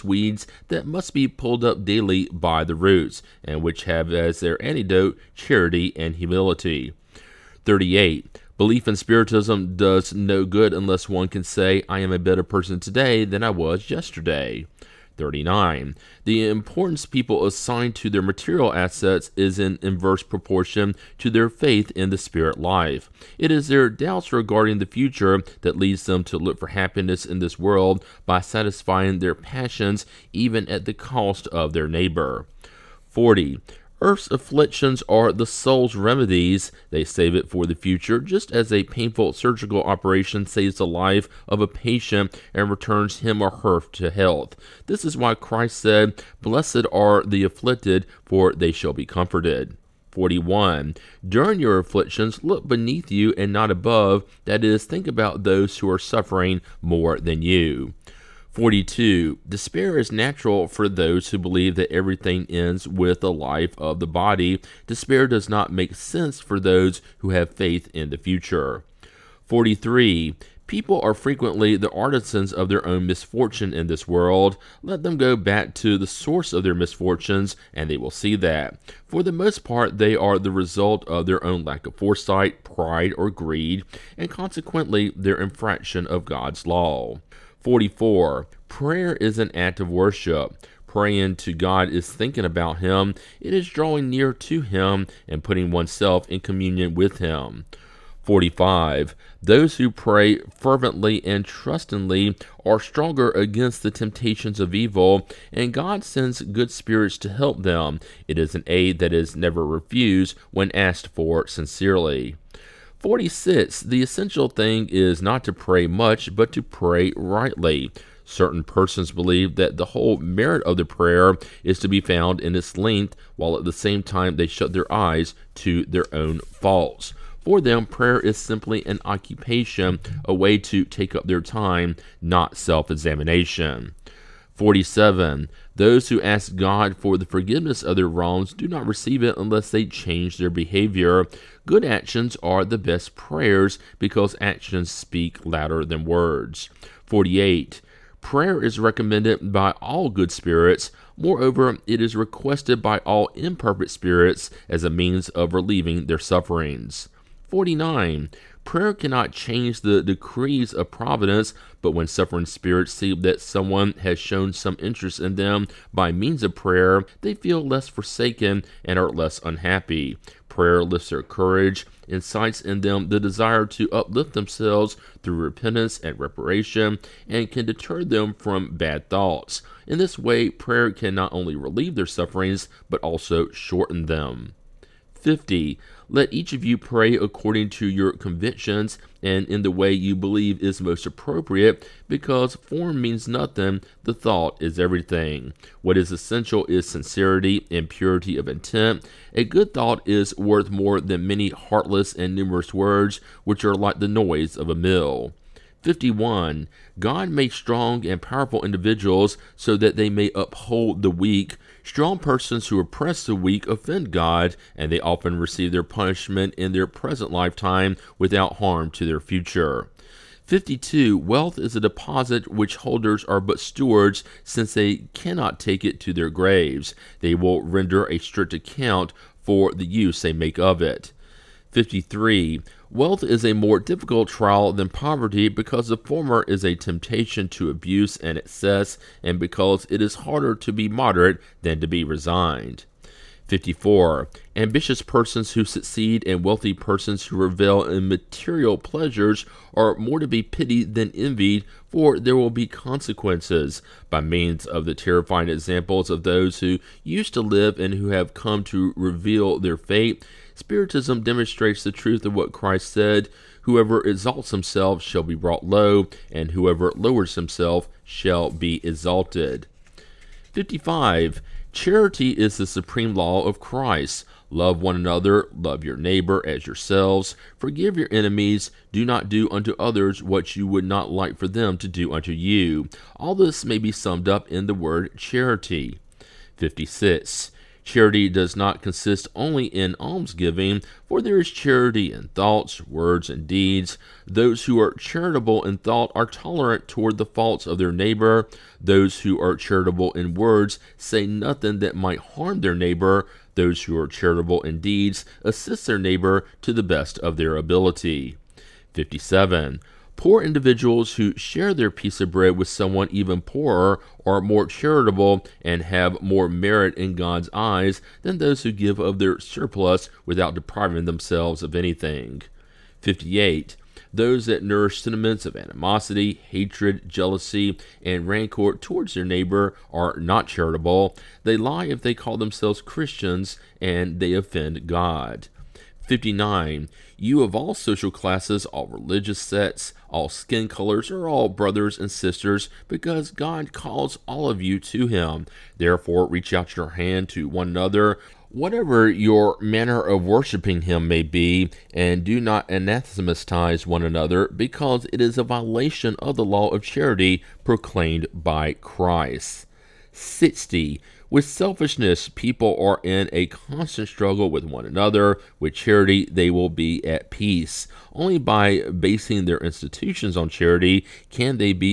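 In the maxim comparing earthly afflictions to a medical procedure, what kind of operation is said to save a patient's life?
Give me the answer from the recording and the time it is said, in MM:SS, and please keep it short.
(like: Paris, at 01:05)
painful surgical operation, at 00:38.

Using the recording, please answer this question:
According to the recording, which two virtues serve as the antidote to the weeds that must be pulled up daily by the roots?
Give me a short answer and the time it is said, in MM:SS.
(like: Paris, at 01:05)
charity and humility, at 00:05.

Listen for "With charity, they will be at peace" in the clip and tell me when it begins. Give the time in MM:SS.
06:05.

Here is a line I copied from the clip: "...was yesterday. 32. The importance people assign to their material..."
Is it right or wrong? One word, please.
wrong.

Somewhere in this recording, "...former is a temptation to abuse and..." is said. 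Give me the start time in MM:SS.
03:55.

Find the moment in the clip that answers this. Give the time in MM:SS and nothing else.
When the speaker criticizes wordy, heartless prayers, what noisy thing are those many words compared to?
03:23.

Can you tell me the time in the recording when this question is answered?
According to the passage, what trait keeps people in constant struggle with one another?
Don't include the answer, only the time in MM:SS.
06:01.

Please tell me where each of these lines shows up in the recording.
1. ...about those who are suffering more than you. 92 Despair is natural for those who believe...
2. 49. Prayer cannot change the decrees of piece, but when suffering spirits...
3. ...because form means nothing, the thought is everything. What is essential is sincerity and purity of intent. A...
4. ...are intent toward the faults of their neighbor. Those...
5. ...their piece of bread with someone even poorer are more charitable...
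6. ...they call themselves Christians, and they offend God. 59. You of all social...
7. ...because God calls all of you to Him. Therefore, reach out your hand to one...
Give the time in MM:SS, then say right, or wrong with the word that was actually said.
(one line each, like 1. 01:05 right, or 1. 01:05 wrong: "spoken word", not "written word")
1. 00:55 wrong: "42", not "92"
2. 02:37 wrong: "providence", not "piece"
3. 03:12 right
4. 04:56 wrong: "tolerant", not "intent"
5. 05:11 right
6. 05:32 right
7. 05:42 right.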